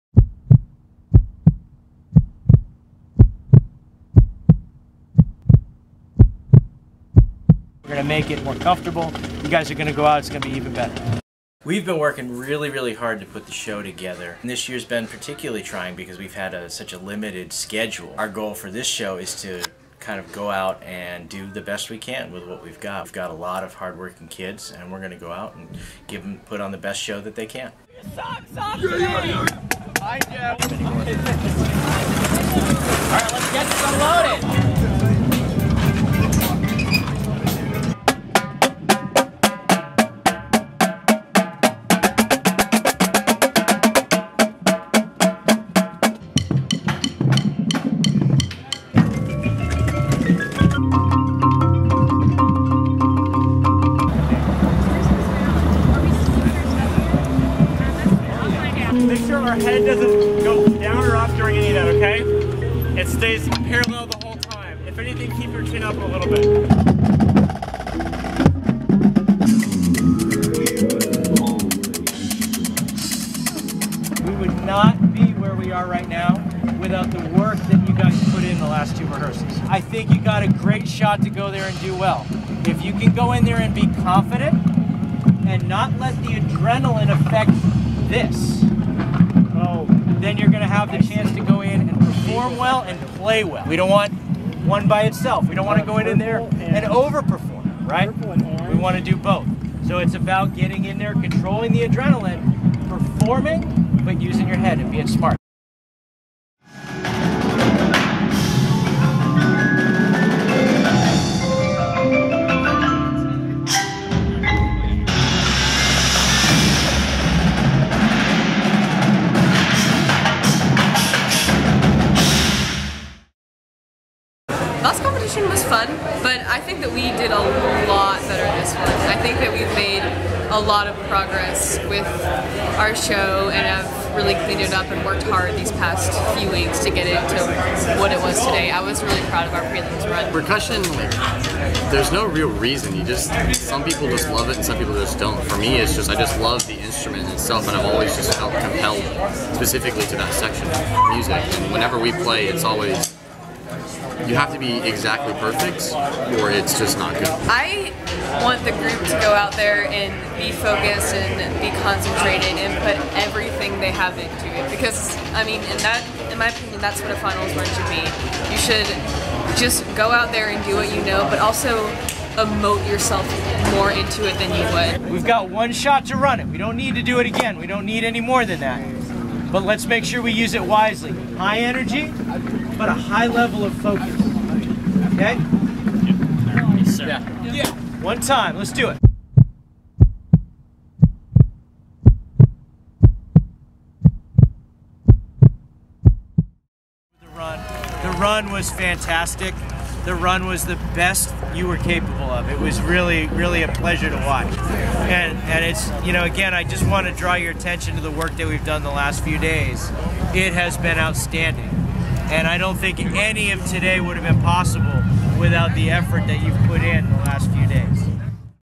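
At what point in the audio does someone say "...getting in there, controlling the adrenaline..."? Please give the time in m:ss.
1:40.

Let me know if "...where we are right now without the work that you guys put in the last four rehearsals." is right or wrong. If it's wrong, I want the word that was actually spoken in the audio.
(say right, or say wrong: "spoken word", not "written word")
wrong: "two", not "four".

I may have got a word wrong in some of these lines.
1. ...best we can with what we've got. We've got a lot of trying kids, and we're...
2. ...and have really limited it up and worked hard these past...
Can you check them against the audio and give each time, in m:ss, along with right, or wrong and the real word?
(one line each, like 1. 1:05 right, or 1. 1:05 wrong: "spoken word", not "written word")
1. 0:21 wrong: "hardworking", not "trying"
2. 2:13 wrong: "cleaned", not "limited".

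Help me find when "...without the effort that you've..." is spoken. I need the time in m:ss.
3:35.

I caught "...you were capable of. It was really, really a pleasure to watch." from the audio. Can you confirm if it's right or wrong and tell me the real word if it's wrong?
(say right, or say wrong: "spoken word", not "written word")
right.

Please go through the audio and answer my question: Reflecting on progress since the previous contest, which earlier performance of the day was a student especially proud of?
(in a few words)
prelims run.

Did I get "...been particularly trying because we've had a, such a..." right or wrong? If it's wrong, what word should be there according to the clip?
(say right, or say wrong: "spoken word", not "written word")
right.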